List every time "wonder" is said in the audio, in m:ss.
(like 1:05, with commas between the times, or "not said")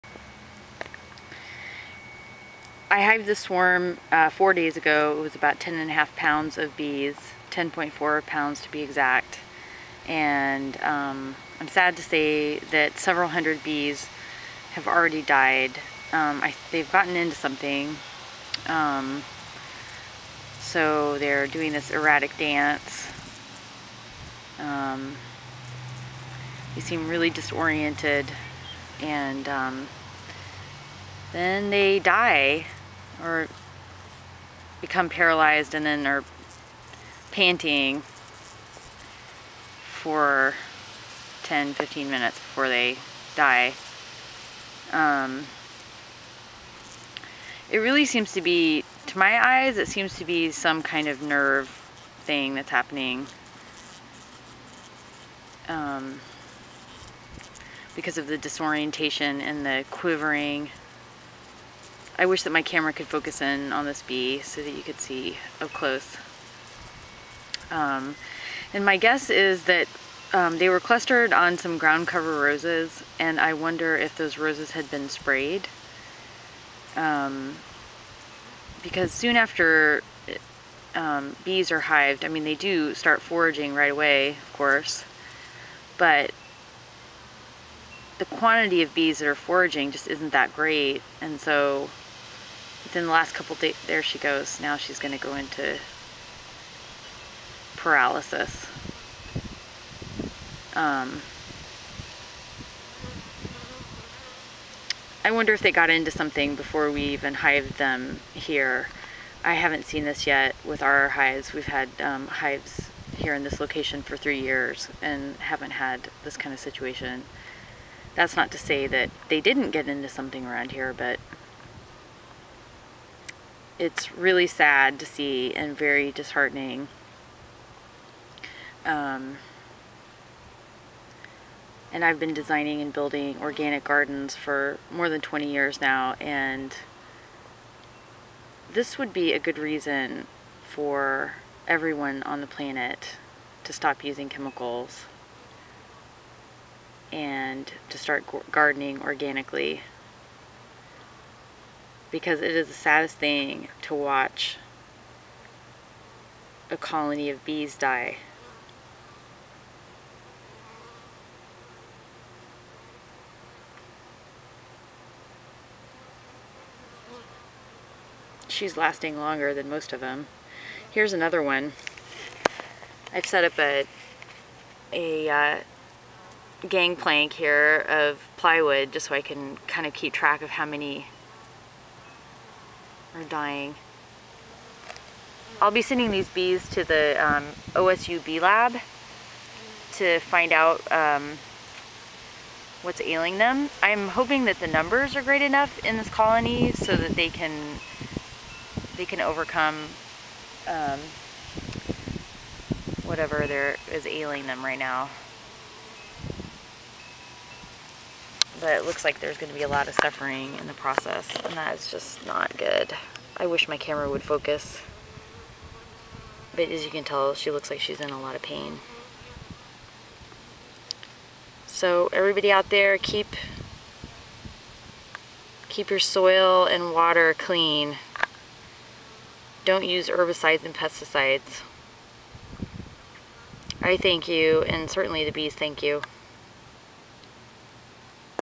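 1:13, 1:45.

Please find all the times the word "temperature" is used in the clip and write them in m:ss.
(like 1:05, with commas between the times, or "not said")
not said.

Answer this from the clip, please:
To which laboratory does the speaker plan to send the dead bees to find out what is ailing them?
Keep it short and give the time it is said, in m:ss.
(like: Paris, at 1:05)
OSU Bee Lab, at 3:07.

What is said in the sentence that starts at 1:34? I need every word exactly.
Now she's going to go into paralysis.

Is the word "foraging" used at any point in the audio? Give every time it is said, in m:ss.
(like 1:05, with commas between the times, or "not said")
1:23, 1:29.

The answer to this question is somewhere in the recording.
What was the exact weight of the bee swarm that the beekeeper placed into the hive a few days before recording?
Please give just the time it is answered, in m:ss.
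0:07.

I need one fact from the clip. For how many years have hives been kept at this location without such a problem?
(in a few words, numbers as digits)
3.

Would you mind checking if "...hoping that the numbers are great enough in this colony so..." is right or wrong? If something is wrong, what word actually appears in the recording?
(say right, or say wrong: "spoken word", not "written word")
right.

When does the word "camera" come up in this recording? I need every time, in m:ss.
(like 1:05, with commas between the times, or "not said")
1:02, 3:33.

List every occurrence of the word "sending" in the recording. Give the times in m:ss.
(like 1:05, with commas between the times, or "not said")
3:05.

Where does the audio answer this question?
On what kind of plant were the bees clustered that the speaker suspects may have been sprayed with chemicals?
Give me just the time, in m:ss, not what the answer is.
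1:11.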